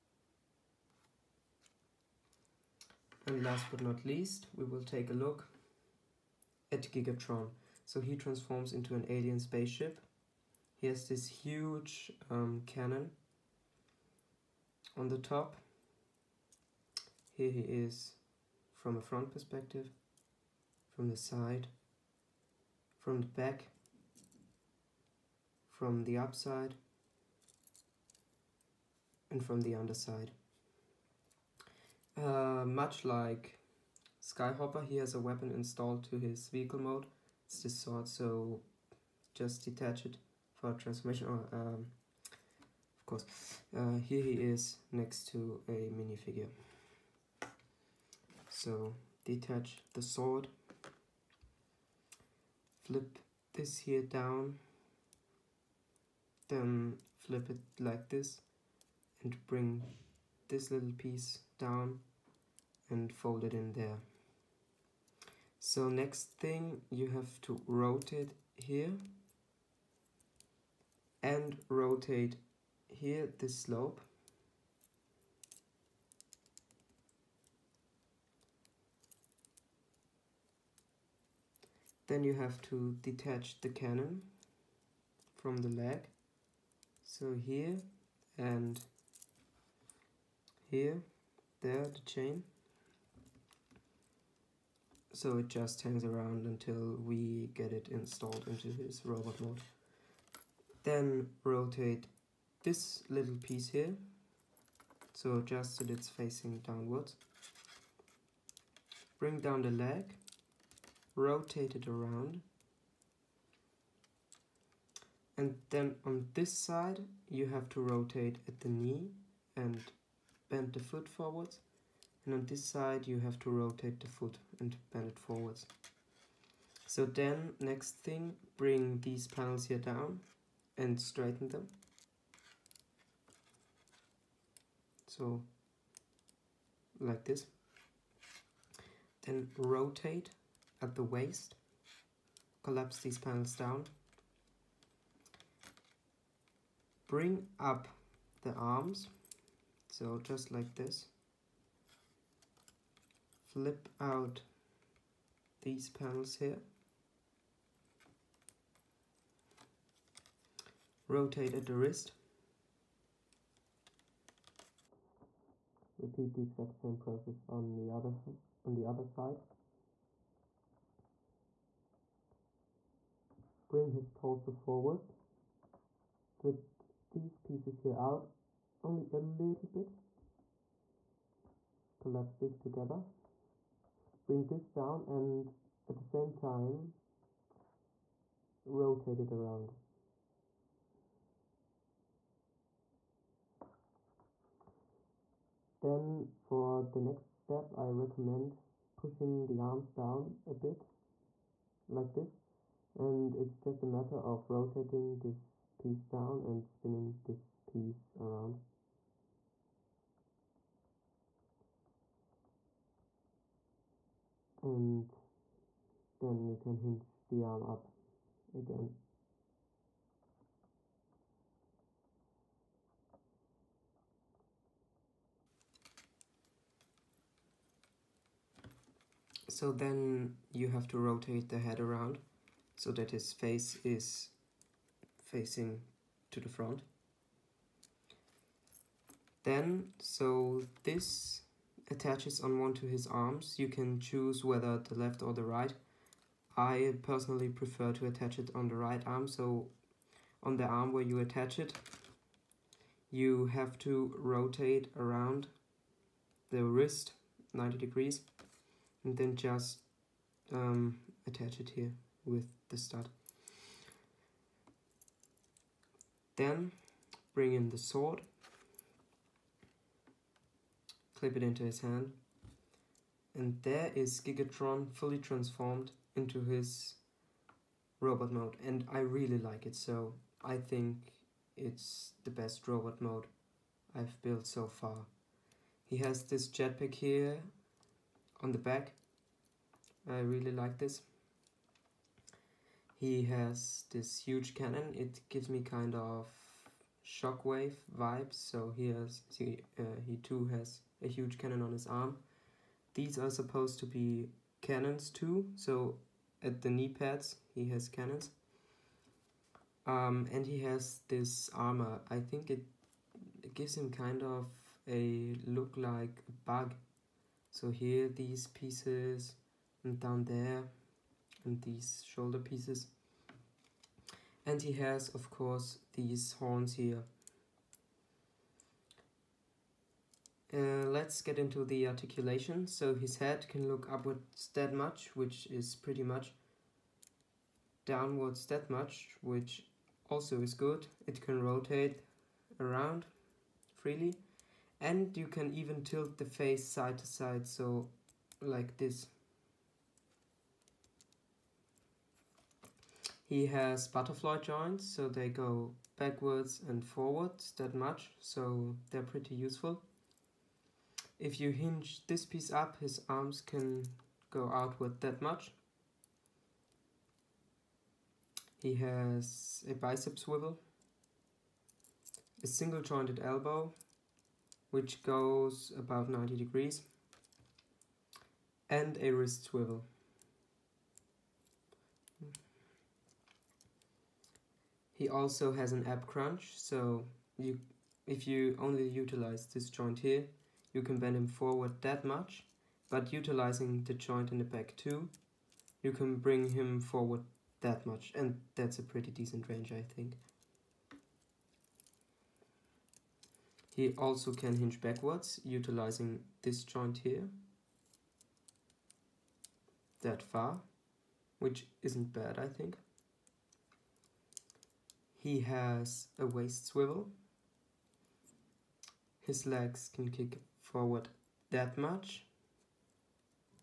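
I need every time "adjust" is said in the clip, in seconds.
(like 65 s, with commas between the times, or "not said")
105 s.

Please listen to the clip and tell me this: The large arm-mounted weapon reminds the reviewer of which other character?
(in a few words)
Shockwave.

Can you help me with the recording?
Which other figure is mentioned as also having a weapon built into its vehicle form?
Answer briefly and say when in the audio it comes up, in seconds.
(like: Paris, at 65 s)
Skyhopper, at 34 s.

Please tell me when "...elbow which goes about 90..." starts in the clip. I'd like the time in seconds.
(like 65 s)
373 s.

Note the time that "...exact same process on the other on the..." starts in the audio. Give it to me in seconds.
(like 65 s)
166 s.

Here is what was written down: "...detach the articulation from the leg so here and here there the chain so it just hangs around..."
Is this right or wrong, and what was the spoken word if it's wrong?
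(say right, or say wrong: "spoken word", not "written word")
wrong: "cannon", not "articulation".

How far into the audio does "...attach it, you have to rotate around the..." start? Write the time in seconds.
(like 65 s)
251 s.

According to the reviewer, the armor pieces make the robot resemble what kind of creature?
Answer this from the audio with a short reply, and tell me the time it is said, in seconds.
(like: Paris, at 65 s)
A bug, at 316 s.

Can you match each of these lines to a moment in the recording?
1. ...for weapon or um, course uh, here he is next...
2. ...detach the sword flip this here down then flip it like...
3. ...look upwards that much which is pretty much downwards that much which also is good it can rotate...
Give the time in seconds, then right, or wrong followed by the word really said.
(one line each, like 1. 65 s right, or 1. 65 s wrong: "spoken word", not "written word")
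1. 40 s wrong: "transformation", not "weapon"
2. 49 s right
3. 333 s right.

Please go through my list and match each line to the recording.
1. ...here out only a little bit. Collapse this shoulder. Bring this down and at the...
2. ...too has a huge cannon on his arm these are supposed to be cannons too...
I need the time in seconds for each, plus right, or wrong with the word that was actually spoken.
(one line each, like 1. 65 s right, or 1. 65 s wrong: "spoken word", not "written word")
1. 177 s wrong: "together", not "shoulder"
2. 300 s right.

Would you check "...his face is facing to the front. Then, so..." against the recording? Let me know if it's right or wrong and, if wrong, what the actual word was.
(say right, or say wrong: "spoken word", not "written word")
right.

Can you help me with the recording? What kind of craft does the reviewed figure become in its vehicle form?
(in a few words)
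Alien spaceship.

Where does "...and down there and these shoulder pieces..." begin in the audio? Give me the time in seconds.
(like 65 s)
319 s.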